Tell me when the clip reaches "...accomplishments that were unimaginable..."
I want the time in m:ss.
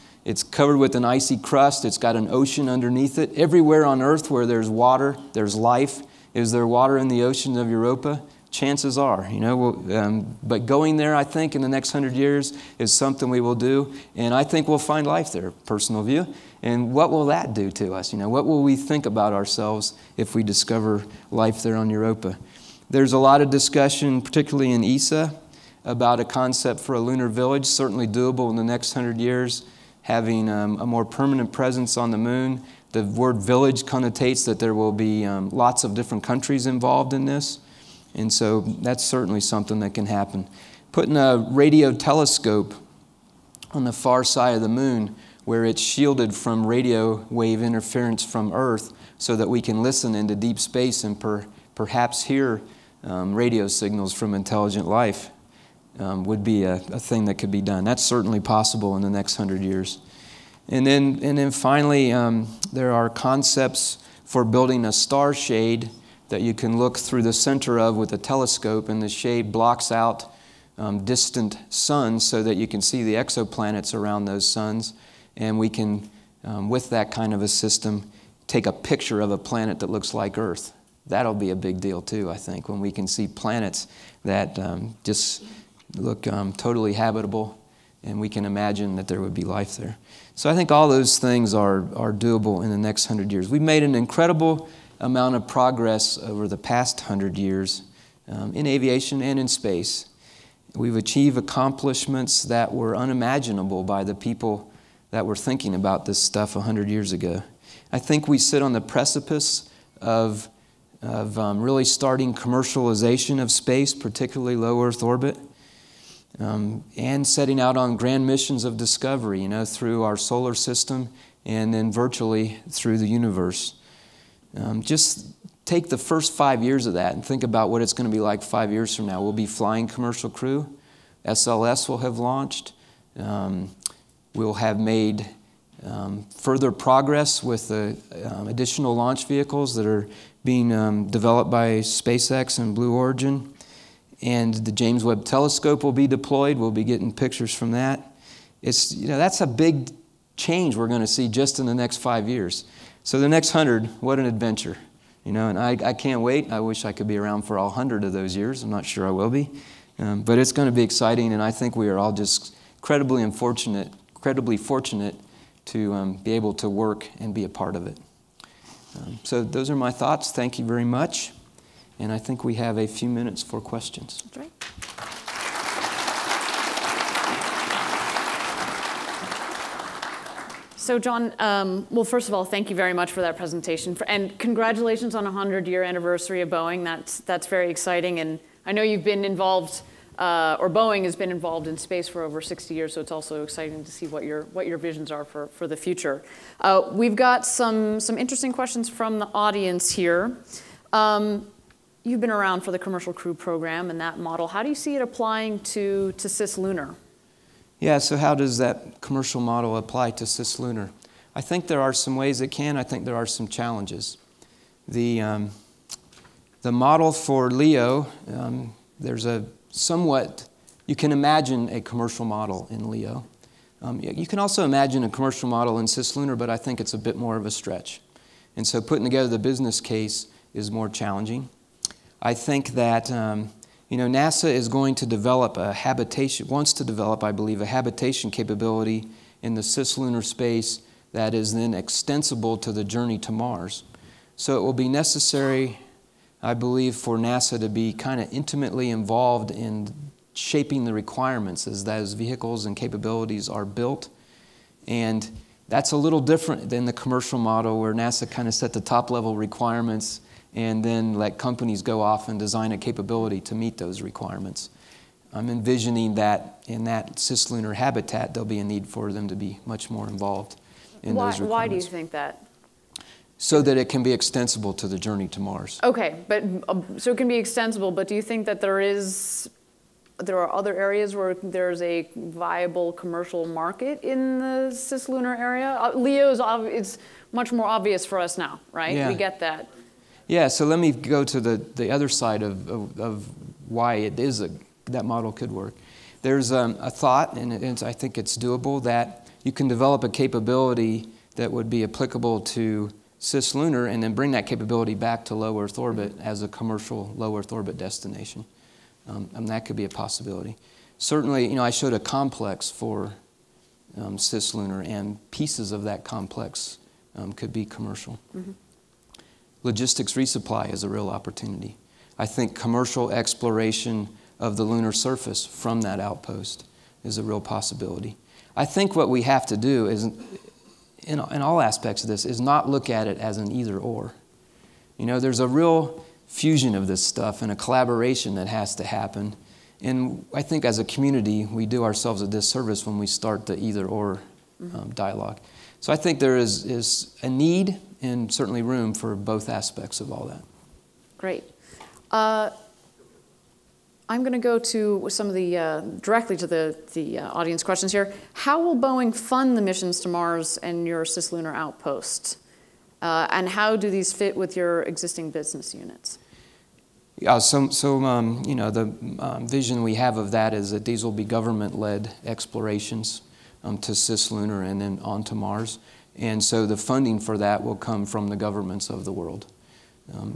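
1:41.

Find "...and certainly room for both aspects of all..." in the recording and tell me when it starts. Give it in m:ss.
5:48.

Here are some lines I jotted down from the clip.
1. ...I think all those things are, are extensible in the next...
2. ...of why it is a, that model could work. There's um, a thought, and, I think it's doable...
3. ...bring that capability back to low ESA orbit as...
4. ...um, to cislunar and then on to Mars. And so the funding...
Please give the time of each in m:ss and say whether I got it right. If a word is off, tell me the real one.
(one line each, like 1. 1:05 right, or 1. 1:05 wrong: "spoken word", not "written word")
1. 1:30 wrong: "doable", not "extensible"
2. 4:52 right
3. 5:04 wrong: "Earth", not "ESA"
4. 6:13 right.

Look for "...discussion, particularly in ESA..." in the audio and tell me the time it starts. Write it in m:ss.
0:23.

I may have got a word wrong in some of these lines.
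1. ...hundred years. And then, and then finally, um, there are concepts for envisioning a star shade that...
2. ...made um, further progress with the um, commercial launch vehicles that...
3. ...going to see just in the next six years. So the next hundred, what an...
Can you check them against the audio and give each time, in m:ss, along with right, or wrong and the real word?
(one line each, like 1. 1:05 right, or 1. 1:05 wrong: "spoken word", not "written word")
1. 0:59 wrong: "building", not "envisioning"
2. 2:14 wrong: "additional", not "commercial"
3. 2:30 wrong: "five", not "six".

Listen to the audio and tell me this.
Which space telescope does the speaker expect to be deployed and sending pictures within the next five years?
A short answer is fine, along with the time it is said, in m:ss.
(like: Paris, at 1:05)
James Webb Telescope, at 2:24.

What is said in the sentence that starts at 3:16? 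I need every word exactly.
Uh, we've got some, some interesting questions from the audience here.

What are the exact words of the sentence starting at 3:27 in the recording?
Yeah, so how does that commercial model apply to cislunar?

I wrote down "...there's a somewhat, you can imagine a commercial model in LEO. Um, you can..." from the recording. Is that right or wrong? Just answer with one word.
right.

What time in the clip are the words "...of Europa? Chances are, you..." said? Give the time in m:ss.
0:07.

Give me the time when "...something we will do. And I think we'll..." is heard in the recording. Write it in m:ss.
0:12.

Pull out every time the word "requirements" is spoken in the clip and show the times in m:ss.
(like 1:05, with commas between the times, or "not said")
4:10, 4:19, 4:24, 4:31.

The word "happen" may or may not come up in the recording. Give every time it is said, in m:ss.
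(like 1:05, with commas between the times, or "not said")
0:40, 5:38.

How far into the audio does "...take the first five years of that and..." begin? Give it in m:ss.
2:05.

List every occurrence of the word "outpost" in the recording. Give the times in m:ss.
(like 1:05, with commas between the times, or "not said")
5:25, 6:01.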